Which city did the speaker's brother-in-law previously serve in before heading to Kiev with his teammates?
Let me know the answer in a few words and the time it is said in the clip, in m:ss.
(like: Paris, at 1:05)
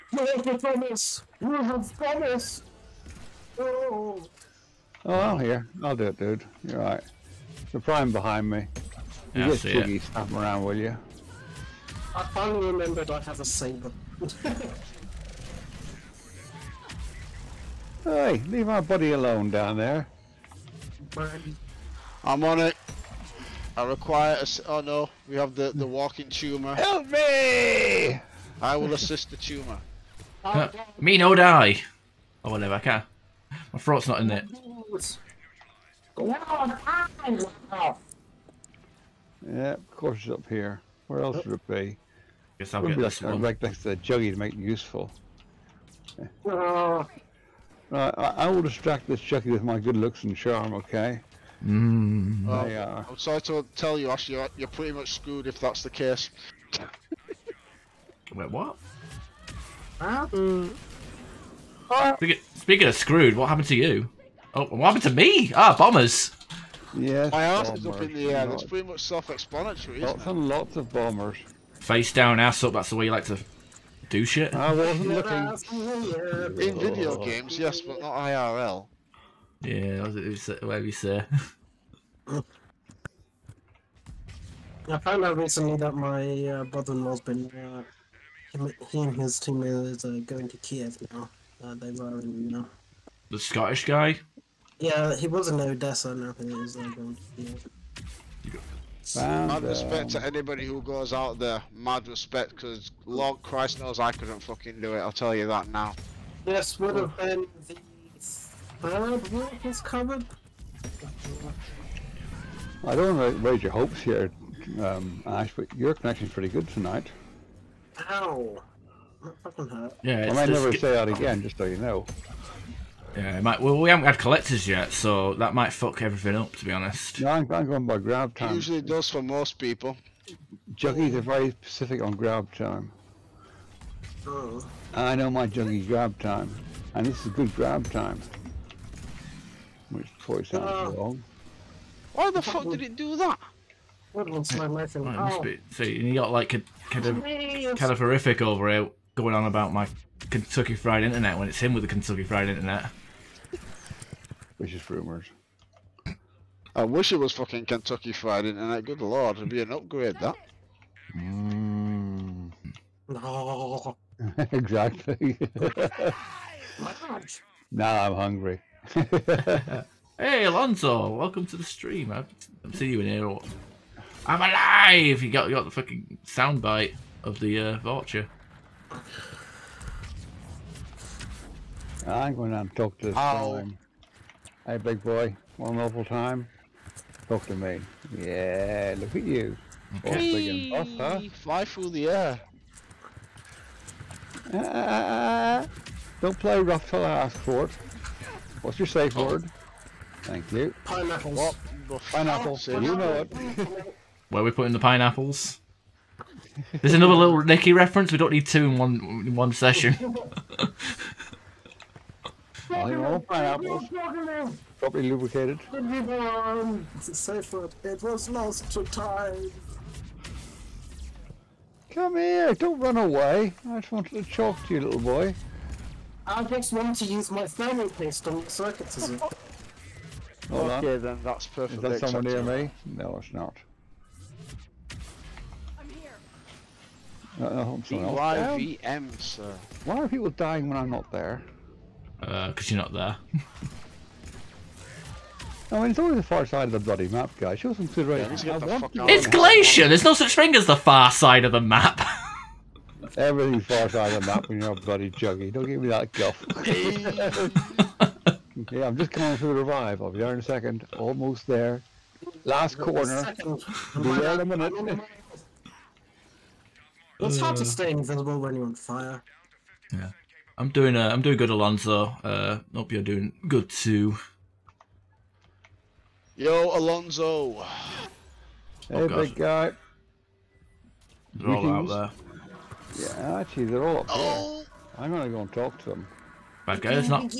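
Odessa, at 1:35.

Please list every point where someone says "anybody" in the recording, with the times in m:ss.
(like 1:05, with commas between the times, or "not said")
1:40.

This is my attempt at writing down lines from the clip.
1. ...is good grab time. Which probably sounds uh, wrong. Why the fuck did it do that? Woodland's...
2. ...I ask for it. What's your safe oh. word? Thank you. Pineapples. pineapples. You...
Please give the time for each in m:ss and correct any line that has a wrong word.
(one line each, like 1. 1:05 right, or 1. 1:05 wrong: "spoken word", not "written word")
1. 2:17 right
2. 3:17 right.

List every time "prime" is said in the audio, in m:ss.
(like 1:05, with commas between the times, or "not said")
0:07.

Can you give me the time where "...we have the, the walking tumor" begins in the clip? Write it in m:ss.
0:25.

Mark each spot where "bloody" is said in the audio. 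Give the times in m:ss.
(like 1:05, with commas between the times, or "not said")
4:06, 4:14.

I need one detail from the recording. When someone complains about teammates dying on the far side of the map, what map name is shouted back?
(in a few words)
Glacier.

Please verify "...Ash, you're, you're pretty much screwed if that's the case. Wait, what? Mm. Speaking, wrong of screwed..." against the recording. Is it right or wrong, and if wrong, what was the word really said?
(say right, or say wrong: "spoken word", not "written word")
wrong: "speaking", not "wrong".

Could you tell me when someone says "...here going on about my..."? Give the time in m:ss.
2:28.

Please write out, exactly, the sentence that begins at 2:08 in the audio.
It usually does for most people.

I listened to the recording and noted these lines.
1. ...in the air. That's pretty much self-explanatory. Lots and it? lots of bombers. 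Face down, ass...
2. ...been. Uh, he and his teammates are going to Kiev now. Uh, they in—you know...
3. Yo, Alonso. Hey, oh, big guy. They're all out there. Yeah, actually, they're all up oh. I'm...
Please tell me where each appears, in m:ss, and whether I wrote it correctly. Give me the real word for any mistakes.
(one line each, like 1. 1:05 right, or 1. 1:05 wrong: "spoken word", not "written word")
1. 1:08 right
2. 1:27 right
3. 4:36 right.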